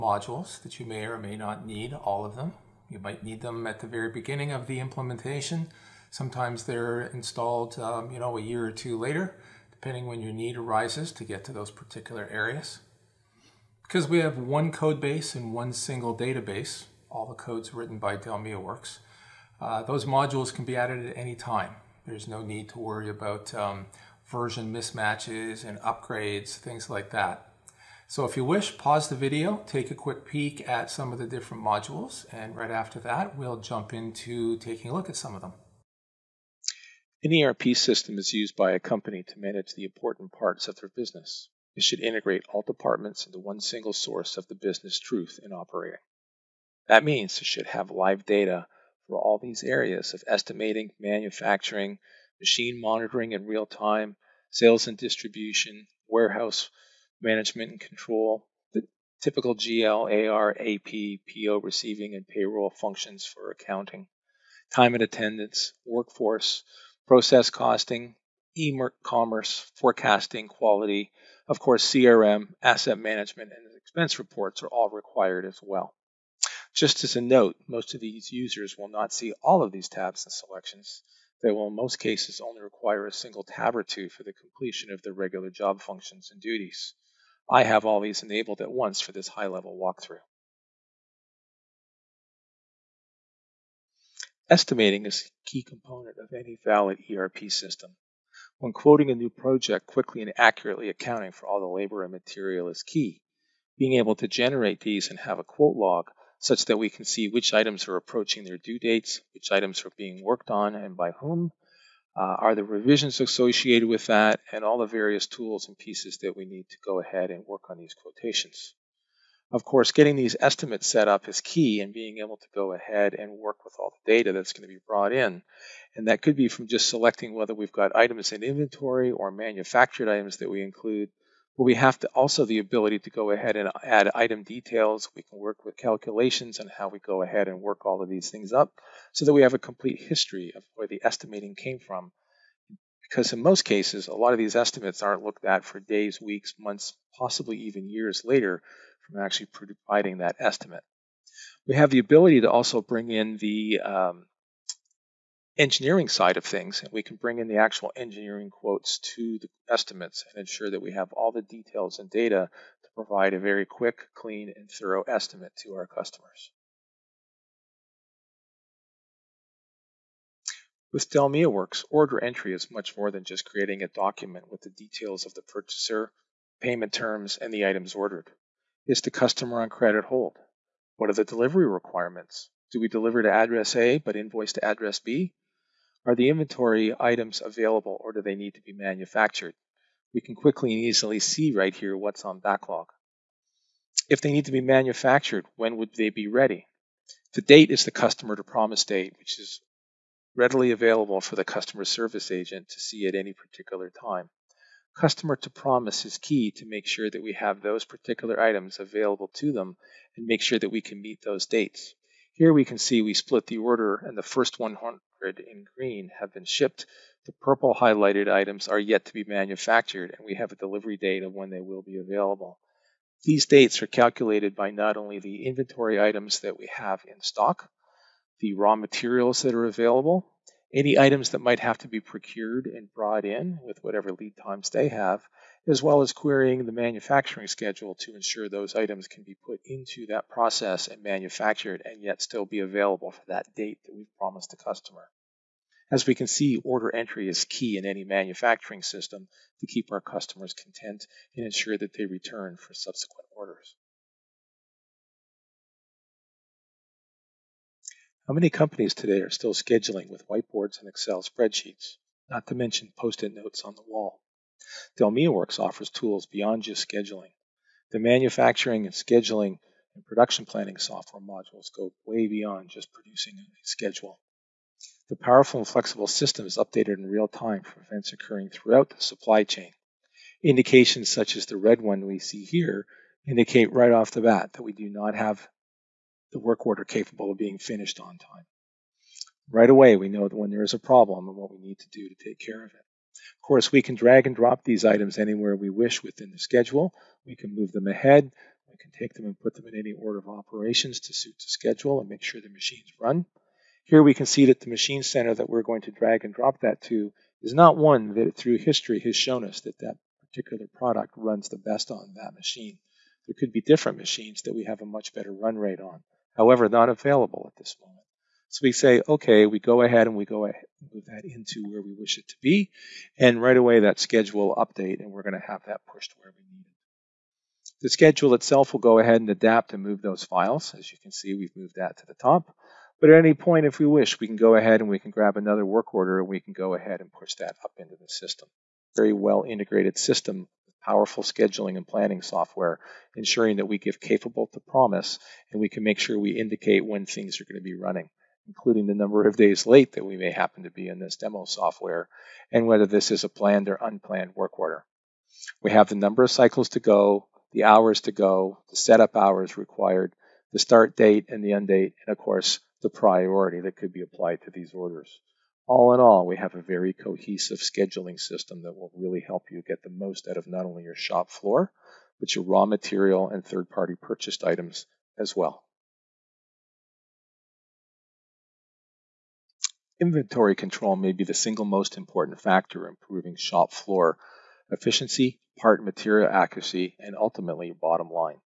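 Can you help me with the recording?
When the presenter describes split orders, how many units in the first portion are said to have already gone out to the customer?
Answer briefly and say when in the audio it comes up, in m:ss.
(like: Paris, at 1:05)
100, at 3:34.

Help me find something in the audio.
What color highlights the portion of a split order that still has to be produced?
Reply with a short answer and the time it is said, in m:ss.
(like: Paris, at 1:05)
Purple, at 3:37.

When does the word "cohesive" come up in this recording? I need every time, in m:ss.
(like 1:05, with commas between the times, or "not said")
6:06.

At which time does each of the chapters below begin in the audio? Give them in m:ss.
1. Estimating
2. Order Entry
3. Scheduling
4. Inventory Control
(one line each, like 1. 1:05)
1. 1:30
2. 2:46
3. 4:13
4. 6:15.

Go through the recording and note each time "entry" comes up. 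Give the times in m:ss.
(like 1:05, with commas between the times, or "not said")
2:52, 4:06.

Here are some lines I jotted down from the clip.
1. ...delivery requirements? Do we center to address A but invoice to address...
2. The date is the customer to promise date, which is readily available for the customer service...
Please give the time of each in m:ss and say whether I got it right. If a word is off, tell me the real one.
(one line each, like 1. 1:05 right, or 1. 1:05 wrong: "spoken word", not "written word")
1. 3:01 wrong: "deliver", not "center"
2. 3:17 right.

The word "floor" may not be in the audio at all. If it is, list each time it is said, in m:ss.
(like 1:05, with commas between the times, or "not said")
6:11, 6:23.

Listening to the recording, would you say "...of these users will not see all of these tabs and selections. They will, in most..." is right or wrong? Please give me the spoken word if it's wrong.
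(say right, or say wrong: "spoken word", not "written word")
right.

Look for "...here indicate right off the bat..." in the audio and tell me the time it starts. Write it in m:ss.
4:42.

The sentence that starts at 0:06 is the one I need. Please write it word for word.
Sometimes they're installed, um, you know, a year or two later, depending when your need arises to get to those particular areas.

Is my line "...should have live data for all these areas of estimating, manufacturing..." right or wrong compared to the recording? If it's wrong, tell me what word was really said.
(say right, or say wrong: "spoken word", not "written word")
right.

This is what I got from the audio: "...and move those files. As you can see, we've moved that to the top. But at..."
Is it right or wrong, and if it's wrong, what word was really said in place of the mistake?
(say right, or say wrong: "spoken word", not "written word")
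right.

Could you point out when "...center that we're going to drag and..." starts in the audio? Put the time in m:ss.
5:05.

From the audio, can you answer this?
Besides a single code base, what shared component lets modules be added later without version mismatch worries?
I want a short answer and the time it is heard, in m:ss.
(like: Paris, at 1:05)
One single database, at 0:15.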